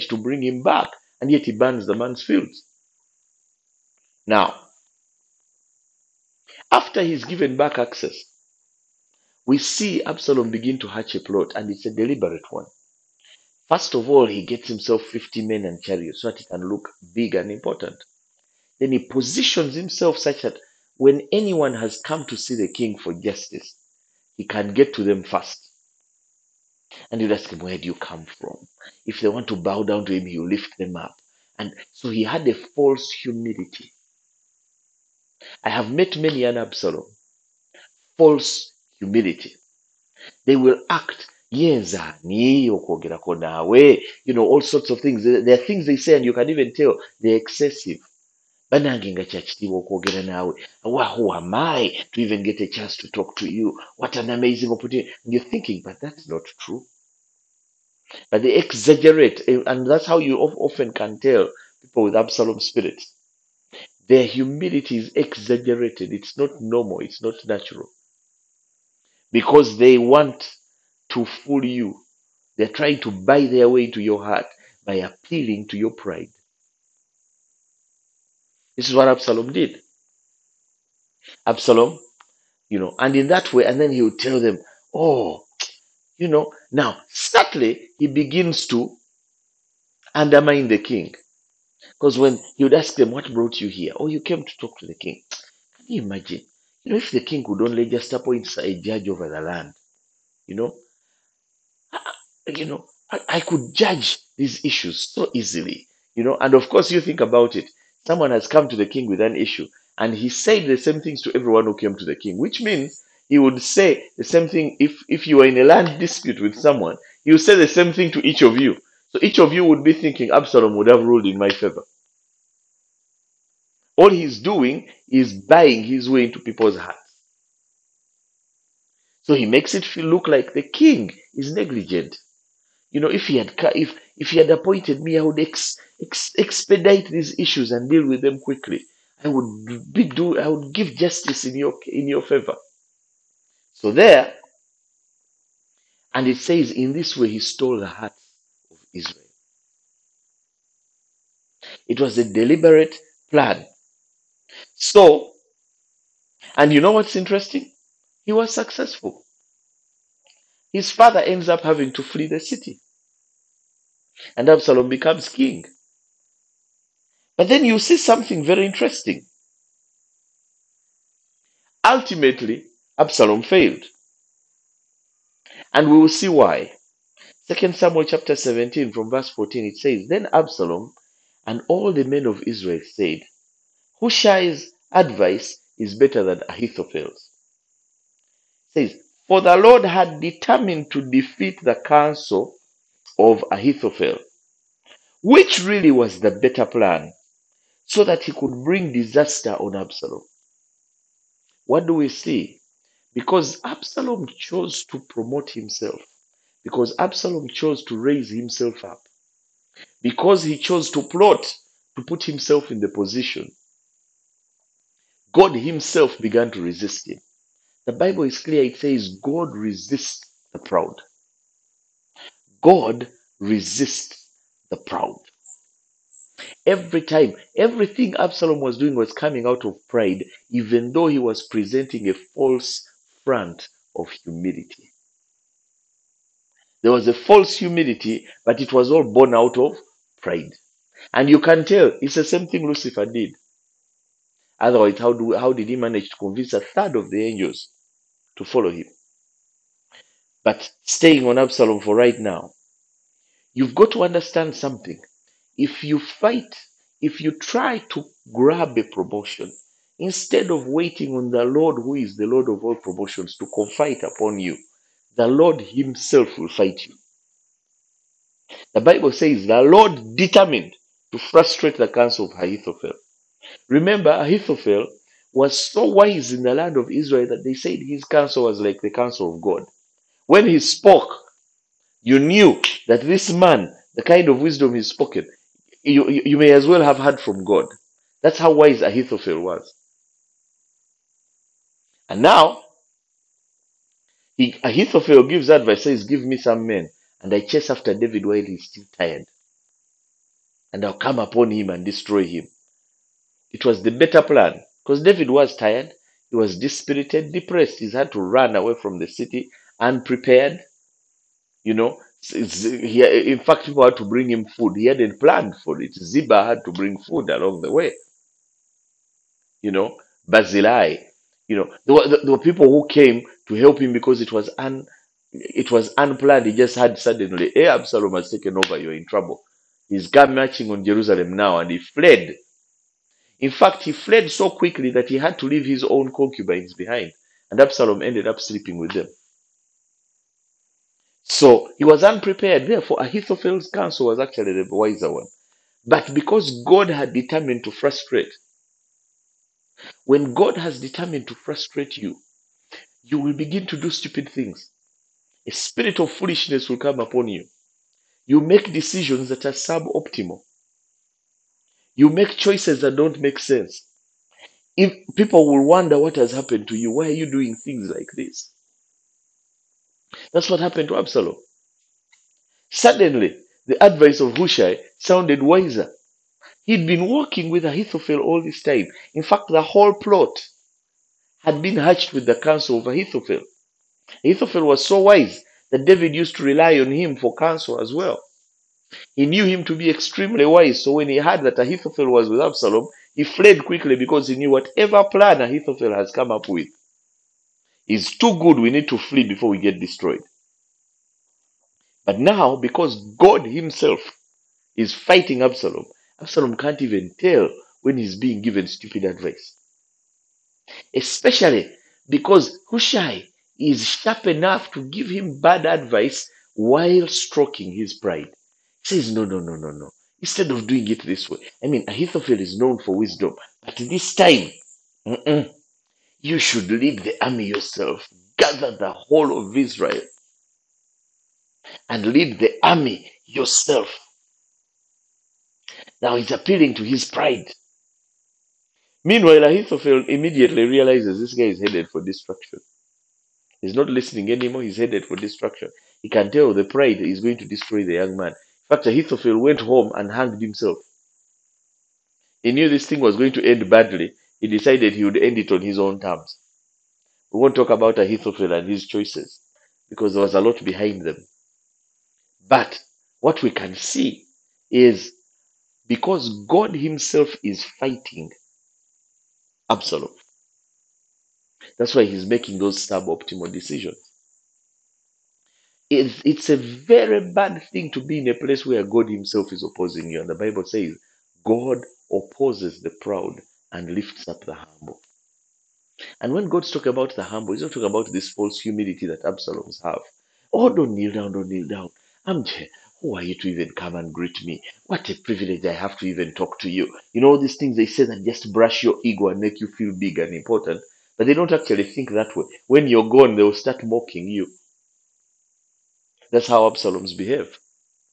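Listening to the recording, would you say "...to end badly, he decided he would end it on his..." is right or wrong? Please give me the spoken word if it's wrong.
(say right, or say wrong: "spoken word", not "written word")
right.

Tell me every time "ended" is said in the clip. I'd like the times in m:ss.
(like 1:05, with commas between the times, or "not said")
5:38.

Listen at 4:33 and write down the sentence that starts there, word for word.
Remember, Ahithophel was so wise in the land of Israel that they said his counsel was like the counsel of God.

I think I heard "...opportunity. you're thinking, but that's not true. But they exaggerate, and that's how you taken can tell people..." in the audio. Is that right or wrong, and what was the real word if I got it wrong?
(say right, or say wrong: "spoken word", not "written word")
wrong: "often", not "taken".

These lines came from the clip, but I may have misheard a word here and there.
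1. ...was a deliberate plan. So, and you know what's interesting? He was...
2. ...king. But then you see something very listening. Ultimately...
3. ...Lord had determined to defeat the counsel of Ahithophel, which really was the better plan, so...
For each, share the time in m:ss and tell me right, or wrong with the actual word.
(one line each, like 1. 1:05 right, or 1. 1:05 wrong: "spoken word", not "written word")
1. 2:31 right
2. 2:45 wrong: "interesting", not "listening"
3. 3:09 right.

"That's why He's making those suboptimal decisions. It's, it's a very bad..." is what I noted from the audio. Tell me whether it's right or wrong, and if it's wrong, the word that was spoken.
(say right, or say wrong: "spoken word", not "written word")
right.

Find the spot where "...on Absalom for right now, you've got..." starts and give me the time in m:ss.
4:11.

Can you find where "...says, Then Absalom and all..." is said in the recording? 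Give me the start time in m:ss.
2:59.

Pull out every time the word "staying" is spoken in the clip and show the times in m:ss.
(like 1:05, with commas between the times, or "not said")
4:10.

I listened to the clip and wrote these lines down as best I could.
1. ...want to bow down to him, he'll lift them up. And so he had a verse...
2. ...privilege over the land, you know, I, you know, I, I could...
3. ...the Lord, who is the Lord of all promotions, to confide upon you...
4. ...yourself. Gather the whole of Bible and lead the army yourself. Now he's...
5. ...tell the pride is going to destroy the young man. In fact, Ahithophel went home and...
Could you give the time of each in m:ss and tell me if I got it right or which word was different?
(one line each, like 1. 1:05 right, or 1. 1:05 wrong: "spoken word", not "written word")
1. 0:29 wrong: "false", not "verse"
2. 1:38 wrong: "judge", not "privilege"
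3. 4:21 right
4. 7:07 wrong: "Israel", not "Bible"
5. 7:26 right.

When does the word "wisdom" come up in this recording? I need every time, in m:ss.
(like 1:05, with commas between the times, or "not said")
4:44, 7:02.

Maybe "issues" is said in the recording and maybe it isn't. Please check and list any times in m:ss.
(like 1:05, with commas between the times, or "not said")
1:44, 1:49, 2:17.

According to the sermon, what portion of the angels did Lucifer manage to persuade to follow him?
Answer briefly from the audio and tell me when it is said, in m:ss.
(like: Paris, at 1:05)
A third, at 4:06.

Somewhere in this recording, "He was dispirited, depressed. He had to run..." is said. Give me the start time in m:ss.
5:06.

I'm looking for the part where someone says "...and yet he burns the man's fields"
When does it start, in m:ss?
0:01.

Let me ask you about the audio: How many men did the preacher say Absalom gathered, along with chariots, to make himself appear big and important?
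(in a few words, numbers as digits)
50.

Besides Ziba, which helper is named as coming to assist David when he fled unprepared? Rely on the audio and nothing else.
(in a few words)
Barzillai.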